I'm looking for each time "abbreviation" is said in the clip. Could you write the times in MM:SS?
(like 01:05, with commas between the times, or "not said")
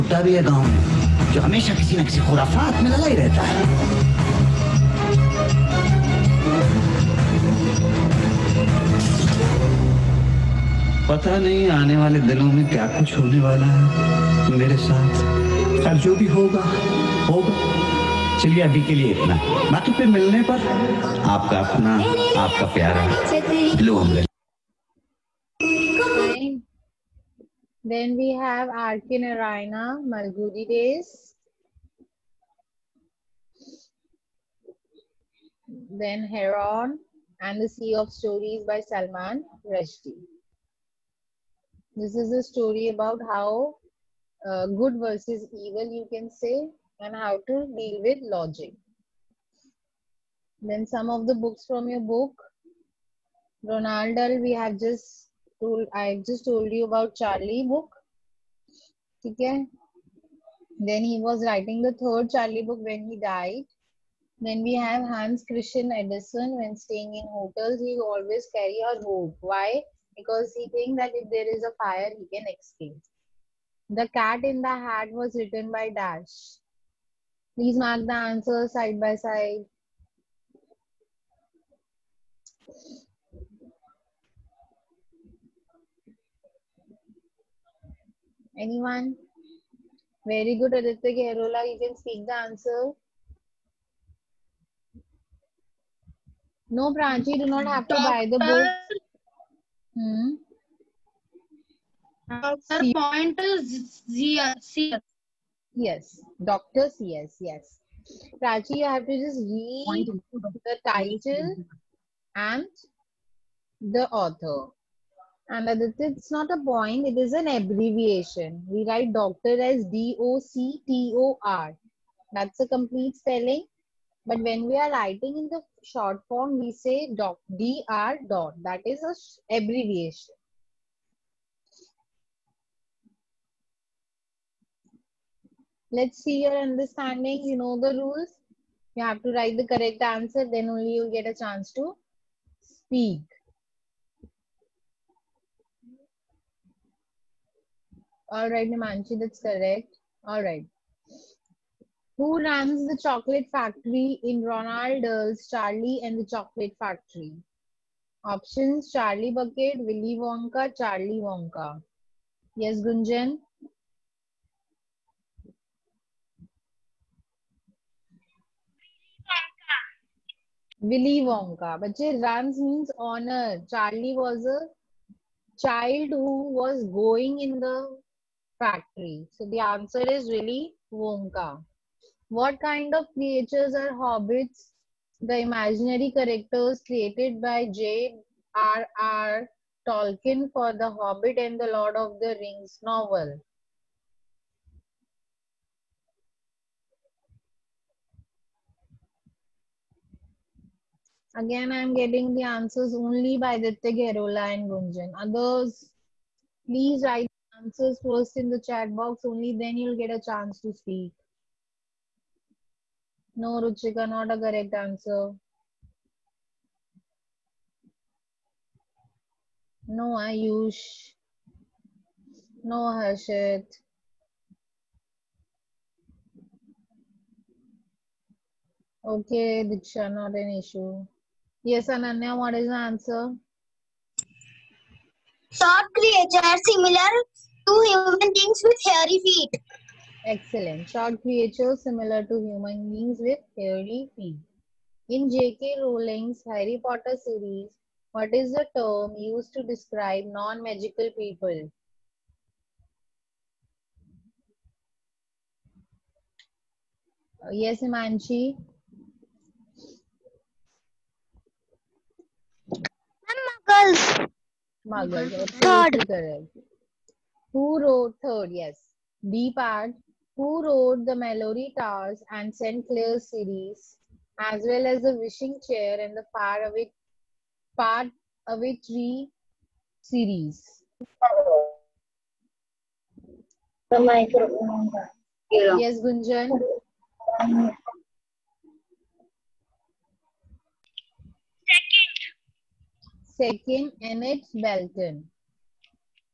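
01:57, 02:09.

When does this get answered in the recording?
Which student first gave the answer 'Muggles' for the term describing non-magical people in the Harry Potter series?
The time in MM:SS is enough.
04:17.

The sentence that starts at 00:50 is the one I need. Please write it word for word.
Then some of the books from your book.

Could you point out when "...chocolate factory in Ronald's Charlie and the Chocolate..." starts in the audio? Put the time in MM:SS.
02:32.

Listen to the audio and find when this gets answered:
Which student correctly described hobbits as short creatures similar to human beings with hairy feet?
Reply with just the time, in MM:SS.
03:51.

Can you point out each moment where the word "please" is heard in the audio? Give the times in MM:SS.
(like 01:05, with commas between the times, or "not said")
01:17, 03:26.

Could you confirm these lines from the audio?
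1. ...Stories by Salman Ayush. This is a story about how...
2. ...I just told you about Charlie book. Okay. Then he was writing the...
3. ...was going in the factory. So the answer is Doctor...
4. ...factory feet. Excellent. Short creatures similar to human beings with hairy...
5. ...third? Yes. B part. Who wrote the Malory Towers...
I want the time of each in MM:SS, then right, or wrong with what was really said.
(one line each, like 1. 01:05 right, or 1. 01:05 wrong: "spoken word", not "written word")
1. 00:38 wrong: "Rushdie", not "Ayush"
2. 00:55 right
3. 02:56 wrong: "Willy", not "Doctor"
4. 03:58 wrong: "hairy", not "factory"
5. 04:28 right.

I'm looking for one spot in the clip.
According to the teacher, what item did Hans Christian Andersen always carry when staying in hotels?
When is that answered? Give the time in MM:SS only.
01:08.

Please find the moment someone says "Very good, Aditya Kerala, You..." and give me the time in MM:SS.
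01:30.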